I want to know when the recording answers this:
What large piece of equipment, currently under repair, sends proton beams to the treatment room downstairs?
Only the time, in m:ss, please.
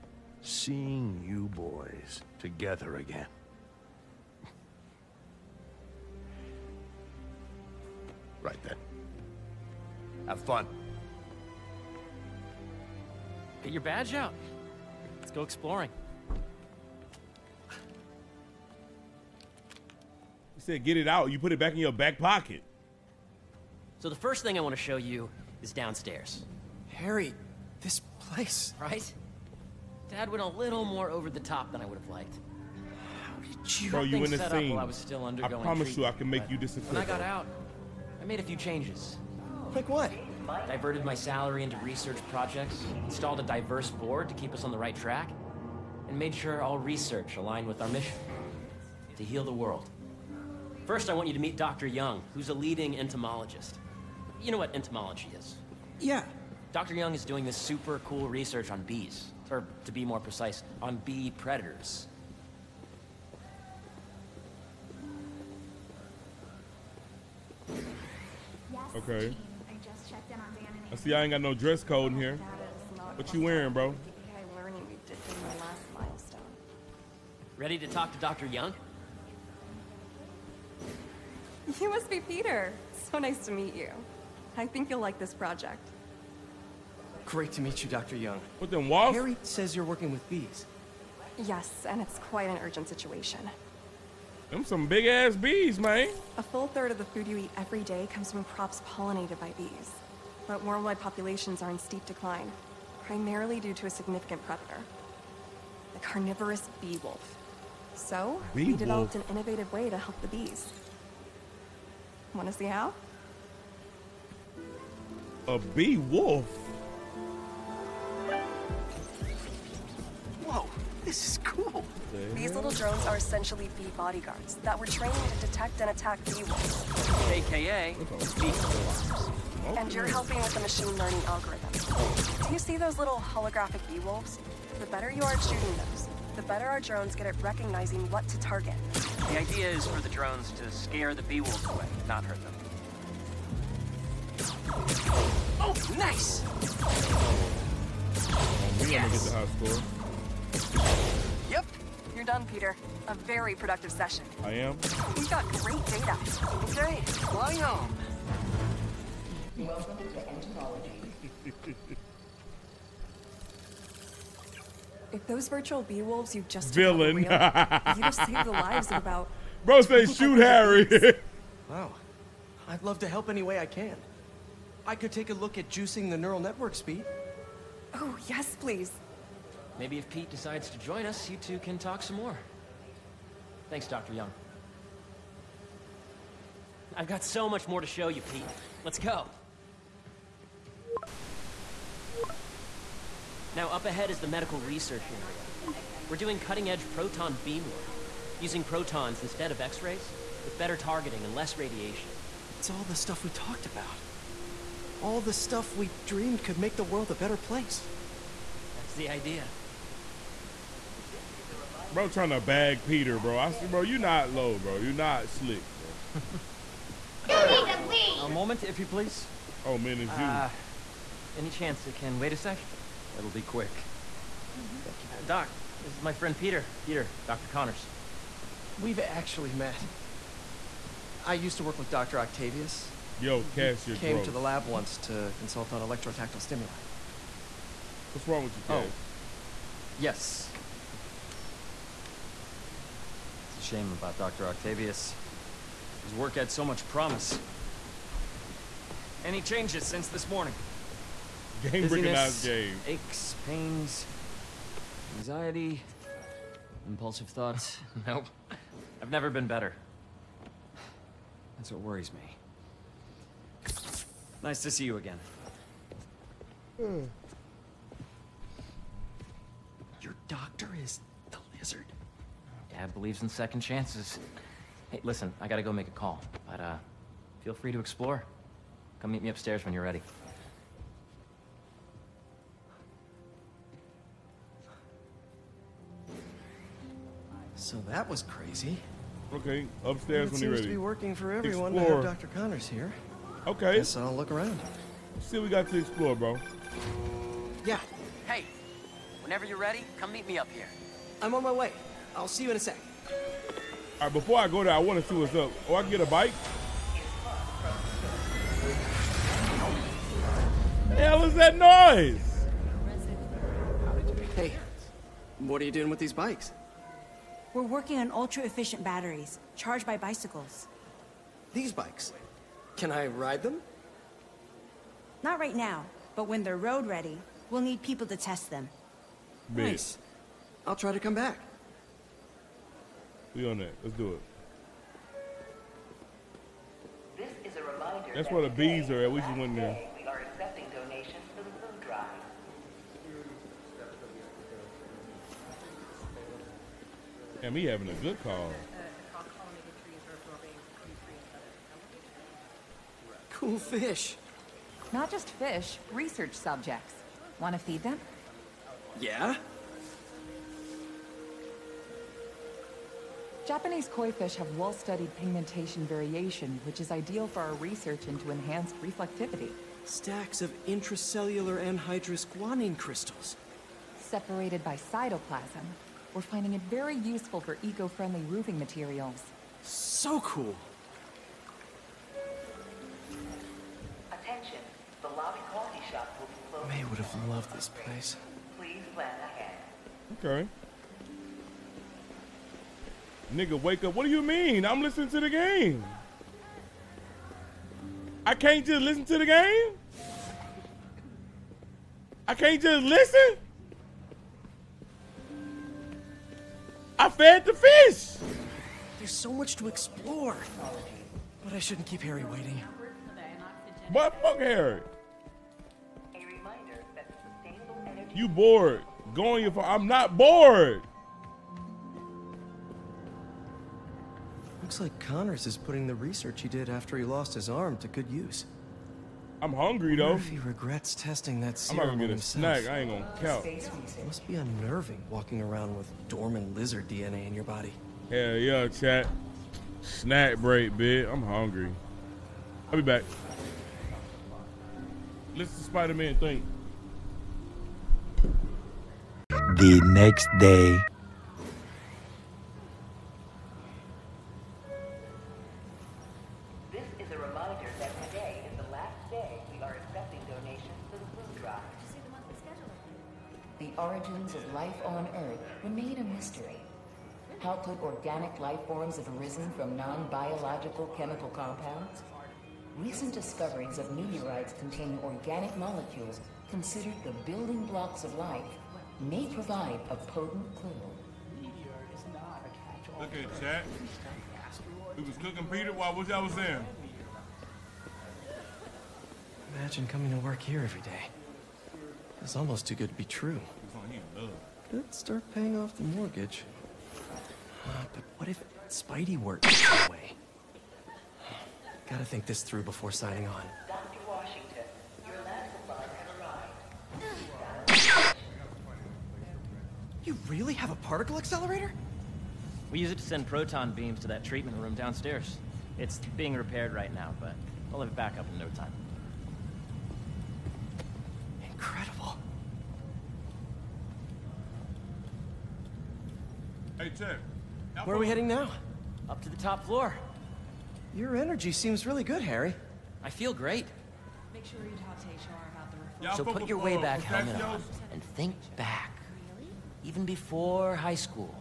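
8:30.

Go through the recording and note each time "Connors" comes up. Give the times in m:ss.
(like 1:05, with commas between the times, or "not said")
3:47, 4:52, 7:04.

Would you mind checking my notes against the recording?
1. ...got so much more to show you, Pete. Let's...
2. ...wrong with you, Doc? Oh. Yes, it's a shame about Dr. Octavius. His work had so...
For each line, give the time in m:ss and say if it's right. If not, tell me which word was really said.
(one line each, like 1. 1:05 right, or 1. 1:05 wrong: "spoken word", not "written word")
1. 3:07 right
2. 3:58 wrong: "Cass", not "Doc".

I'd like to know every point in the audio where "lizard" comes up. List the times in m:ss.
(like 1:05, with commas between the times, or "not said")
4:31, 7:16.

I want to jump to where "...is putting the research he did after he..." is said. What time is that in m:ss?
7:05.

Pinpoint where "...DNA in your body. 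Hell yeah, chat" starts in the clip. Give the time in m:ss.
7:16.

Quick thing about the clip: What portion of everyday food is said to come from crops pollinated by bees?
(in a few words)
A full third.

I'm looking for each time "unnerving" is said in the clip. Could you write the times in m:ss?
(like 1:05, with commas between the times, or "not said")
7:14.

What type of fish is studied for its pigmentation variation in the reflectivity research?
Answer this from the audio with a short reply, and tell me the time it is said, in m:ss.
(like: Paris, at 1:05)
Japanese koi, at 6:03.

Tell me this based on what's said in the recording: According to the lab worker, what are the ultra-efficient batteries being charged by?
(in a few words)
Bicycles.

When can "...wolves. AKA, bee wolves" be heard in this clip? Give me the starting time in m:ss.
2:06.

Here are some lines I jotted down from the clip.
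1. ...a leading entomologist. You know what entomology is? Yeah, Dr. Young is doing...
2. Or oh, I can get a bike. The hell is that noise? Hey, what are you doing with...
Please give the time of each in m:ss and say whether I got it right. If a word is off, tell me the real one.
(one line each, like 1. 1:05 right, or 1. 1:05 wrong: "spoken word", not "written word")
1. 0:52 right
2. 5:05 right.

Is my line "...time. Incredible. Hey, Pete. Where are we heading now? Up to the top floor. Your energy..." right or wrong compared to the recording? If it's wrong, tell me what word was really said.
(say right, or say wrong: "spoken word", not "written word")
wrong: "Tim", not "Pete".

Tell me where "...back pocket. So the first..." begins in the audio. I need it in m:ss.
0:21.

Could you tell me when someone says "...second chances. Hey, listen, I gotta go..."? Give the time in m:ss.
4:33.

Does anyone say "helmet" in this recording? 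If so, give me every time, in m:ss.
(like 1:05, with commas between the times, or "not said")
8:57.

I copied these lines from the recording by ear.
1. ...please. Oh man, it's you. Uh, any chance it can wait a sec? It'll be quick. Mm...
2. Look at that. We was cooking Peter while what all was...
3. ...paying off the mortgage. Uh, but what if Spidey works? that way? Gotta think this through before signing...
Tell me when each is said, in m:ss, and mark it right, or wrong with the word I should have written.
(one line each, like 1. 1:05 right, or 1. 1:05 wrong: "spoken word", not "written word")
1. 3:38 right
2. 8:02 right
3. 8:15 right.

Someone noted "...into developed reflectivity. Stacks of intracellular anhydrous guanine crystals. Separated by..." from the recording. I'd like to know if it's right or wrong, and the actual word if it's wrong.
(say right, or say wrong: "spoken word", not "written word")
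wrong: "enhanced", not "developed".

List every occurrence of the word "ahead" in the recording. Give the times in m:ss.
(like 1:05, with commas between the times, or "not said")
3:13, 6:29.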